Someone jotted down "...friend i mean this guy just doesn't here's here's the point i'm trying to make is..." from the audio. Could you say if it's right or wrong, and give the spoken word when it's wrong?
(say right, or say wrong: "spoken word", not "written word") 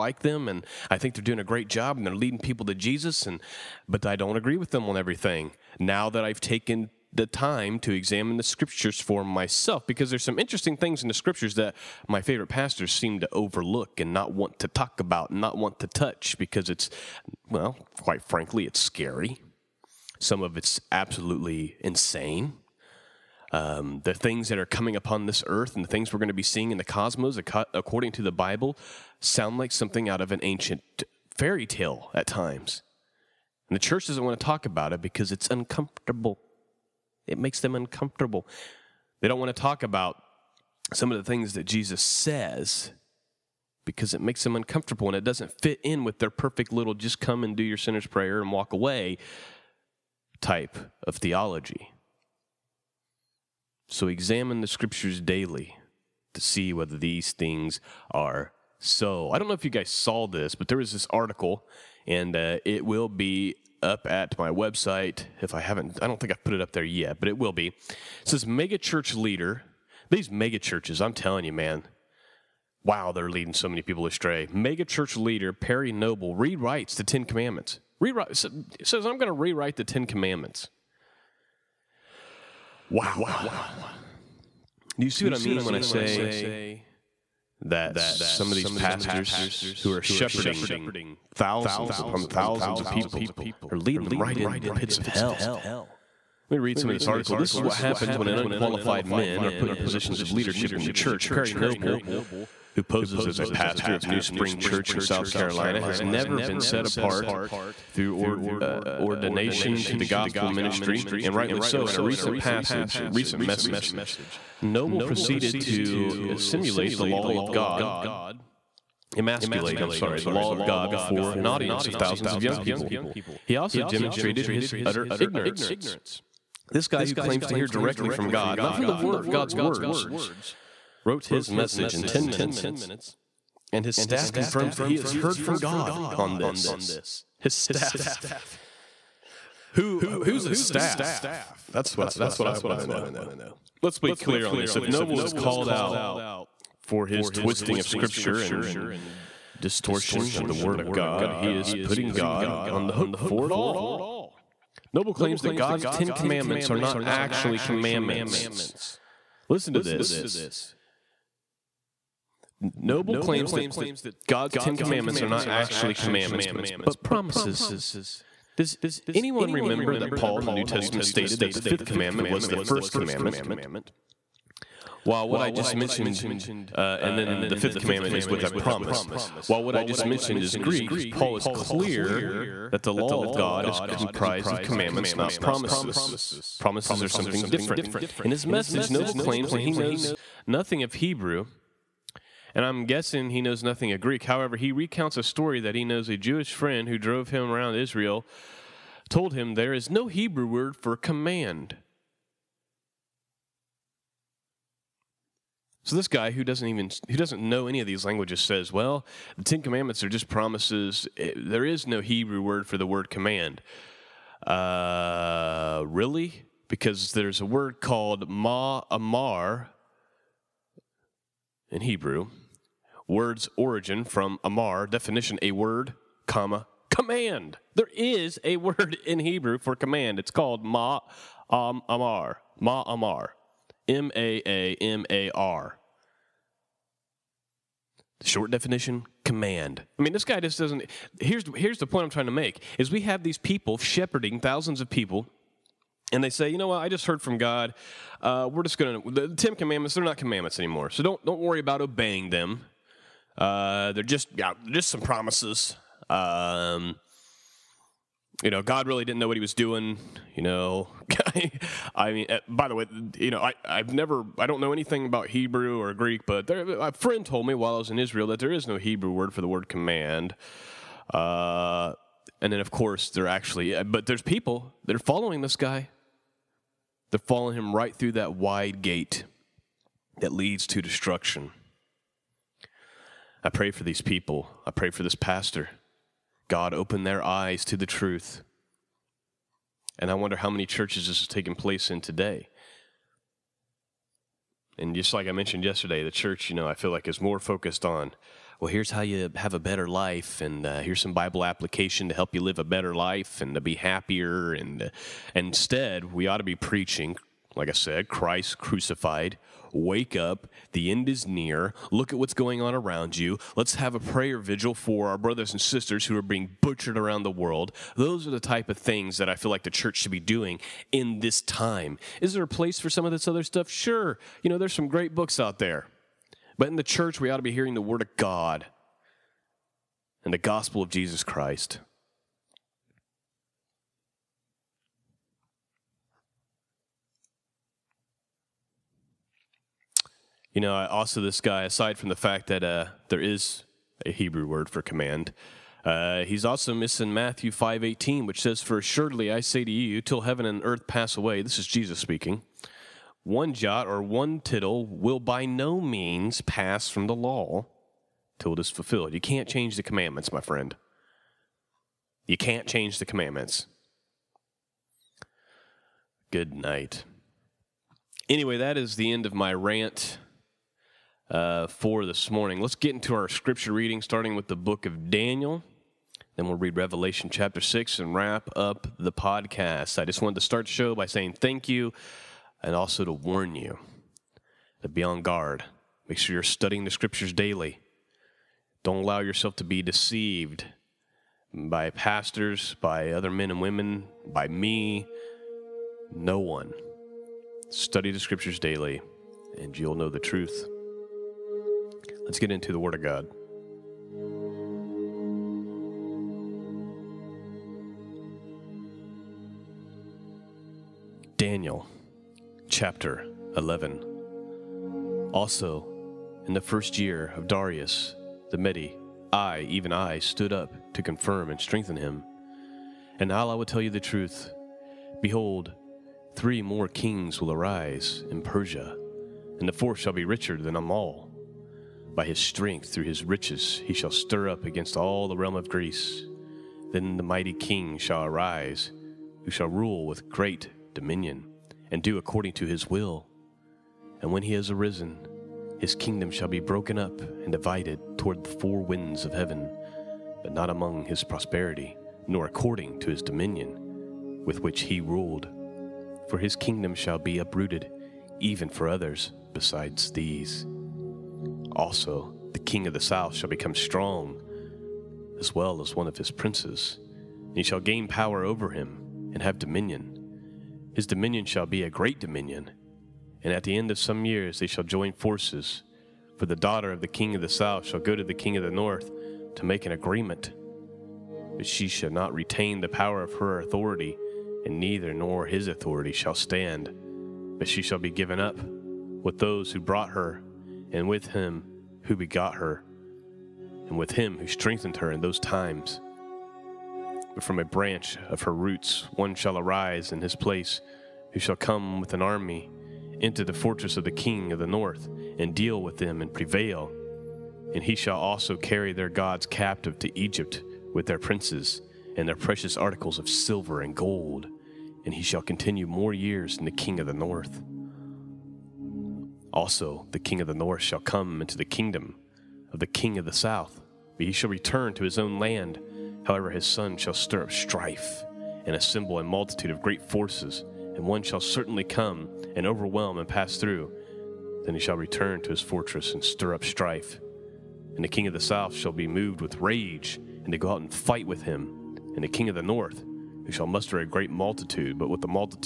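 wrong: "command", not "friend".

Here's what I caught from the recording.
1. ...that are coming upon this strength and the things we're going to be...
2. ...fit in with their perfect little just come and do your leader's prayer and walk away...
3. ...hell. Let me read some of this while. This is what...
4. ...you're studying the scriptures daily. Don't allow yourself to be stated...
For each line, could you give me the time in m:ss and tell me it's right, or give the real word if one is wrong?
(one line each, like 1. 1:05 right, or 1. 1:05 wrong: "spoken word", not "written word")
1. 0:24 wrong: "earth", not "strength"
2. 0:45 wrong: "sinner", not "leader"
3. 1:35 wrong: "article", not "while"
4. 6:26 wrong: "deceived", not "stated".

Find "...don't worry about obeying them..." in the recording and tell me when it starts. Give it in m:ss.
4:11.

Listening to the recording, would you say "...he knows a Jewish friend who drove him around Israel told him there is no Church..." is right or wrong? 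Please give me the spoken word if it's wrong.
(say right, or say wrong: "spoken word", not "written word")
wrong: "Hebrew", not "Church".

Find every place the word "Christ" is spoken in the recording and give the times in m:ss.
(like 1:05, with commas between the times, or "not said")
5:08, 5:31.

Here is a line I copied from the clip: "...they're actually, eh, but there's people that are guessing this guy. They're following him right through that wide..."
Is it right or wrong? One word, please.
wrong.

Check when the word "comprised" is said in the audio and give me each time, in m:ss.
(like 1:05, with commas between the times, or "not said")
3:03.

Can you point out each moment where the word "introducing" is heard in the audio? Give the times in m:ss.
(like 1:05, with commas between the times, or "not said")
not said.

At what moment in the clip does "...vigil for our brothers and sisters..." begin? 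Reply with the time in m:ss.
5:14.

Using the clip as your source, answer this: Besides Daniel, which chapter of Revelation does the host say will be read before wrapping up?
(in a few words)
Chapter 6.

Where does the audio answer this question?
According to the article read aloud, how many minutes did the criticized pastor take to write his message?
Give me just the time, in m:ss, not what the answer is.
2:12.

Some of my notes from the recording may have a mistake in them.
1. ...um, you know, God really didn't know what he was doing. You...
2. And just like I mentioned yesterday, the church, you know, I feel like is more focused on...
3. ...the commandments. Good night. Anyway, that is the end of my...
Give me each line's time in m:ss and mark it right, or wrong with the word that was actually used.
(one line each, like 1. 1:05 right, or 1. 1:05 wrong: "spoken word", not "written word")
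1. 4:16 right
2. 4:54 right
3. 6:02 right.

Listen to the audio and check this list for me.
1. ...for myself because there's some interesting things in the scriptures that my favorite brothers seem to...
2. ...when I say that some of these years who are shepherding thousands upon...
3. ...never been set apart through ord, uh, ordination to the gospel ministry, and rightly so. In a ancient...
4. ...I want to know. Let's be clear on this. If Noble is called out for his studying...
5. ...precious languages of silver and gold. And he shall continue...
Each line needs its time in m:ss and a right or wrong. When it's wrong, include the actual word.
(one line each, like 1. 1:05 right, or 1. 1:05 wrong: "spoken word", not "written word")
1. 0:08 wrong: "pastors", not "brothers"
2. 1:25 wrong: "pastors", not "years"
3. 1:46 wrong: "recent", not "ancient"
4. 2:22 wrong: "twisting", not "studying"
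5. 8:32 wrong: "articles", not "languages".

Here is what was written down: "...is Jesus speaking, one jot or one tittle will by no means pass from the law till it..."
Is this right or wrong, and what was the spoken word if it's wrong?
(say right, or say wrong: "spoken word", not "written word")
right.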